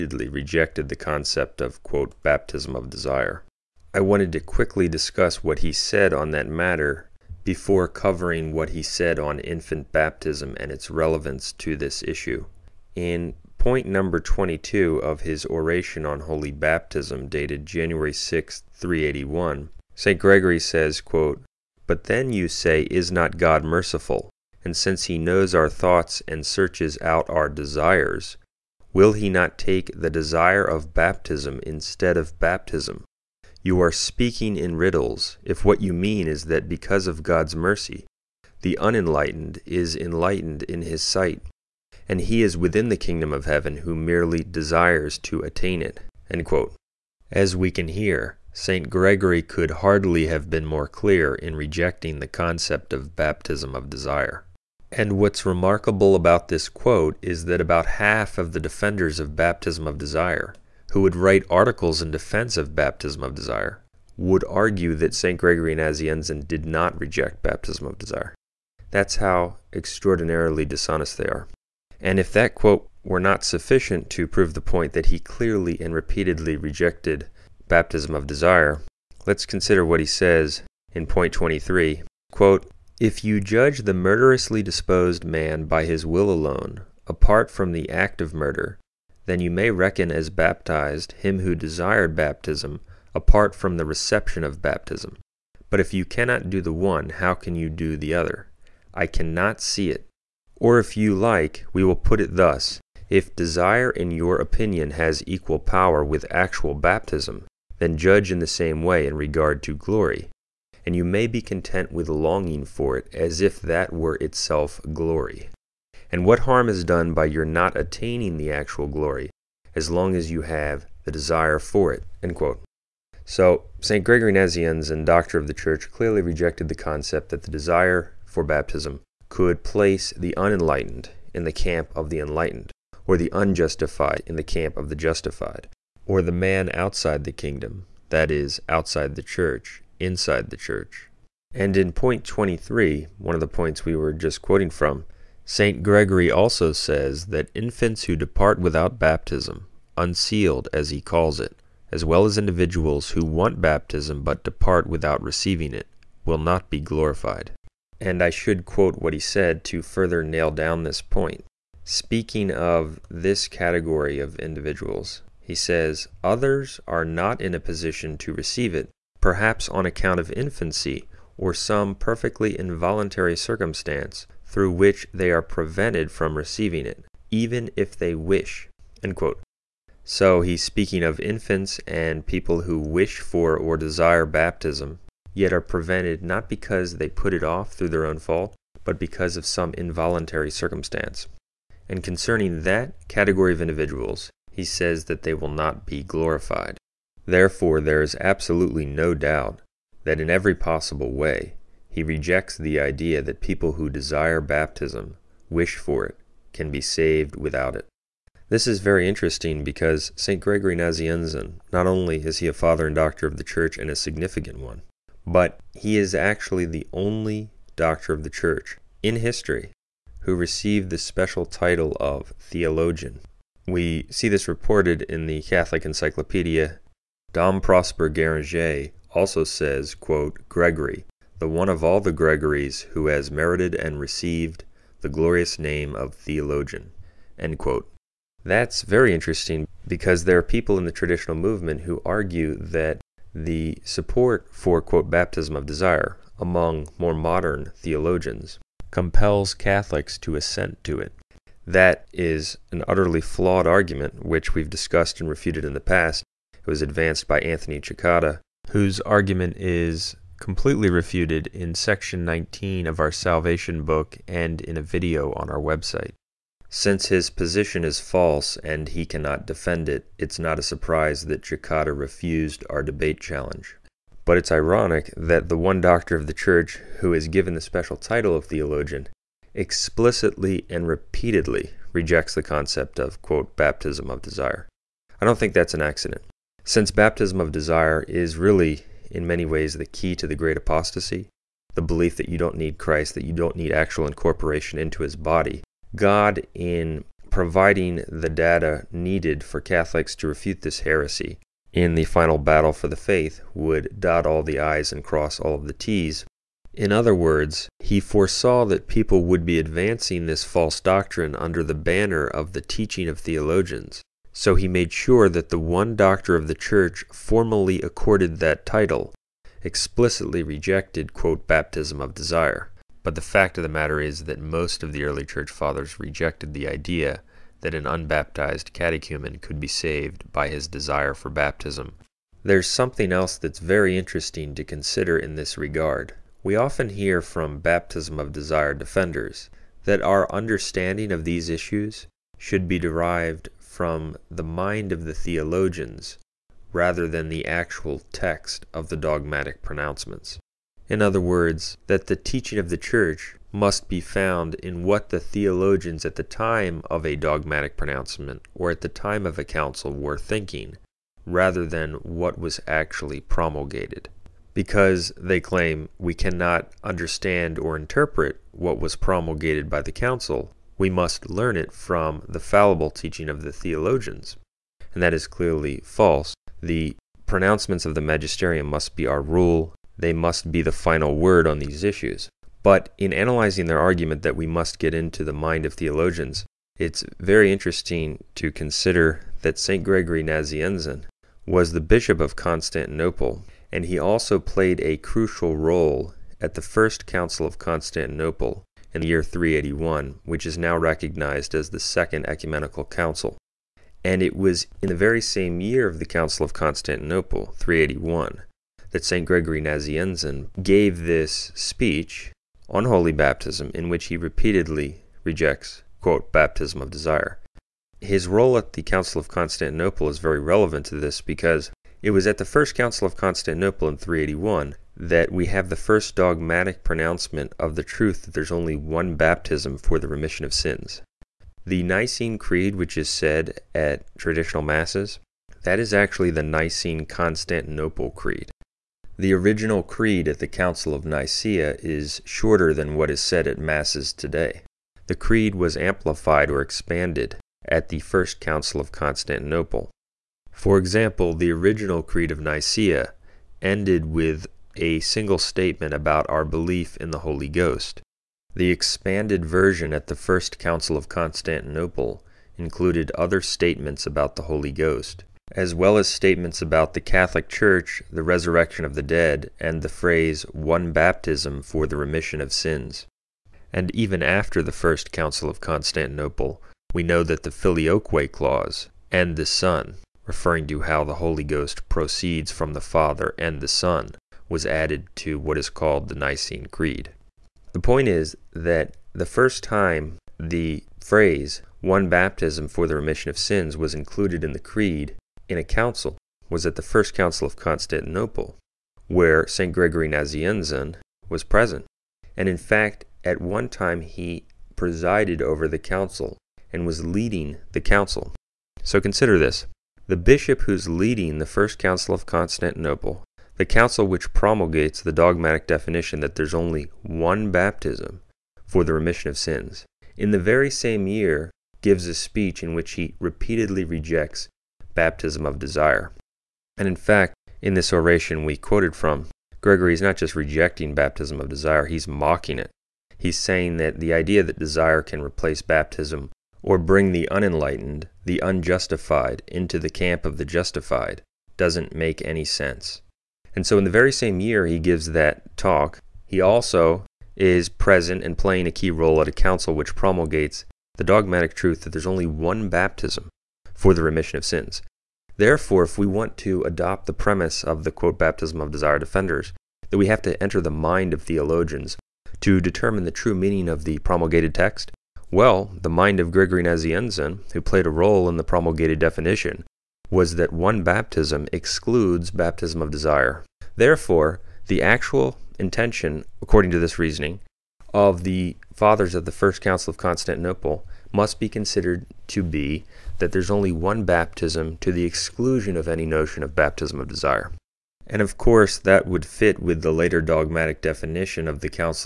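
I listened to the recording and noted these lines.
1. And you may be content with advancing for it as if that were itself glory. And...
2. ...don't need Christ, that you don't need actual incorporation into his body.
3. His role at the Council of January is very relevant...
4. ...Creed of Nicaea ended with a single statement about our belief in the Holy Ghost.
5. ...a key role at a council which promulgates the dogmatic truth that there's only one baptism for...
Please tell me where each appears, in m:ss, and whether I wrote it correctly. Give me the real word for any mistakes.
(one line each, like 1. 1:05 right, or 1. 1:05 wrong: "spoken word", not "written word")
1. 1:50 wrong: "longing", not "advancing"
2. 4:52 right
3. 6:57 wrong: "Constantinople", not "January"
4. 7:32 right
5. 9:08 right.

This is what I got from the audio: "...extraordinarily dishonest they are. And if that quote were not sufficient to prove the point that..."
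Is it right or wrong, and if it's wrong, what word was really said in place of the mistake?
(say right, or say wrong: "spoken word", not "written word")
right.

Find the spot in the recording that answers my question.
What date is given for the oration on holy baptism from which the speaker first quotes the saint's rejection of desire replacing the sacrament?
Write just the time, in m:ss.
0:17.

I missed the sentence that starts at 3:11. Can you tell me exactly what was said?
And concerning that category of individuals, he says that they will not be glorified.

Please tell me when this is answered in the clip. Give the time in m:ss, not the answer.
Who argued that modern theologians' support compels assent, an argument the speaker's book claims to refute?
4:17.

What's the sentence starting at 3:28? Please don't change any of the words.
This is very interesting because St.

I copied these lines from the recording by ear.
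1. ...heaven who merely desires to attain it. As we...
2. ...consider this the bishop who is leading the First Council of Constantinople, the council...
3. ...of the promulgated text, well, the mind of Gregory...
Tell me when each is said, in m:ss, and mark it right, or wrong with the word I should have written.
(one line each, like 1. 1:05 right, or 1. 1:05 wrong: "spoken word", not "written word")
1. 0:43 right
2. 8:29 right
3. 9:23 right.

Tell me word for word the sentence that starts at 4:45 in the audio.
I don't think that's an accident.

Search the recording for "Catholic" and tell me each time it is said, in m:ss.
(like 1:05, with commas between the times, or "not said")
3:45, 4:09, 4:59, 7:46.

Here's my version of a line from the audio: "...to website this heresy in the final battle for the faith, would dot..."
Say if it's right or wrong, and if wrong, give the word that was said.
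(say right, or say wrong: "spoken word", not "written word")
wrong: "refute", not "website".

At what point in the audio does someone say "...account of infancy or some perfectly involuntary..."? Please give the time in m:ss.
2:49.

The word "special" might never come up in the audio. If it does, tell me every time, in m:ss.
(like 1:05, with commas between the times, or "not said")
3:40, 4:37.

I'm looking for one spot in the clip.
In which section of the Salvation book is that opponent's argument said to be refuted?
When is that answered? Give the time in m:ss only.
4:21.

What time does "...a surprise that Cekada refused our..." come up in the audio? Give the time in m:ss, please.
4:30.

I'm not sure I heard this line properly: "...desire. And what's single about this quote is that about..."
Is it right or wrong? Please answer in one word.
wrong.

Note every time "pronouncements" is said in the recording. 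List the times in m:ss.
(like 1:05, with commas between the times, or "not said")
5:49, 5:57, 6:17, 7:06.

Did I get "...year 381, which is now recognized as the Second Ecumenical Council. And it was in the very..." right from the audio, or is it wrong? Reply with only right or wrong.
right.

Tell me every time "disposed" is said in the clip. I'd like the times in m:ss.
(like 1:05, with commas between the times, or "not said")
1:24.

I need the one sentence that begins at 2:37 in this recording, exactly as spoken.
And I should quote what he said to further nail down this point.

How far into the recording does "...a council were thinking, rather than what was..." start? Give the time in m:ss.
5:59.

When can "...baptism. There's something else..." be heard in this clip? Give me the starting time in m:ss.
5:31.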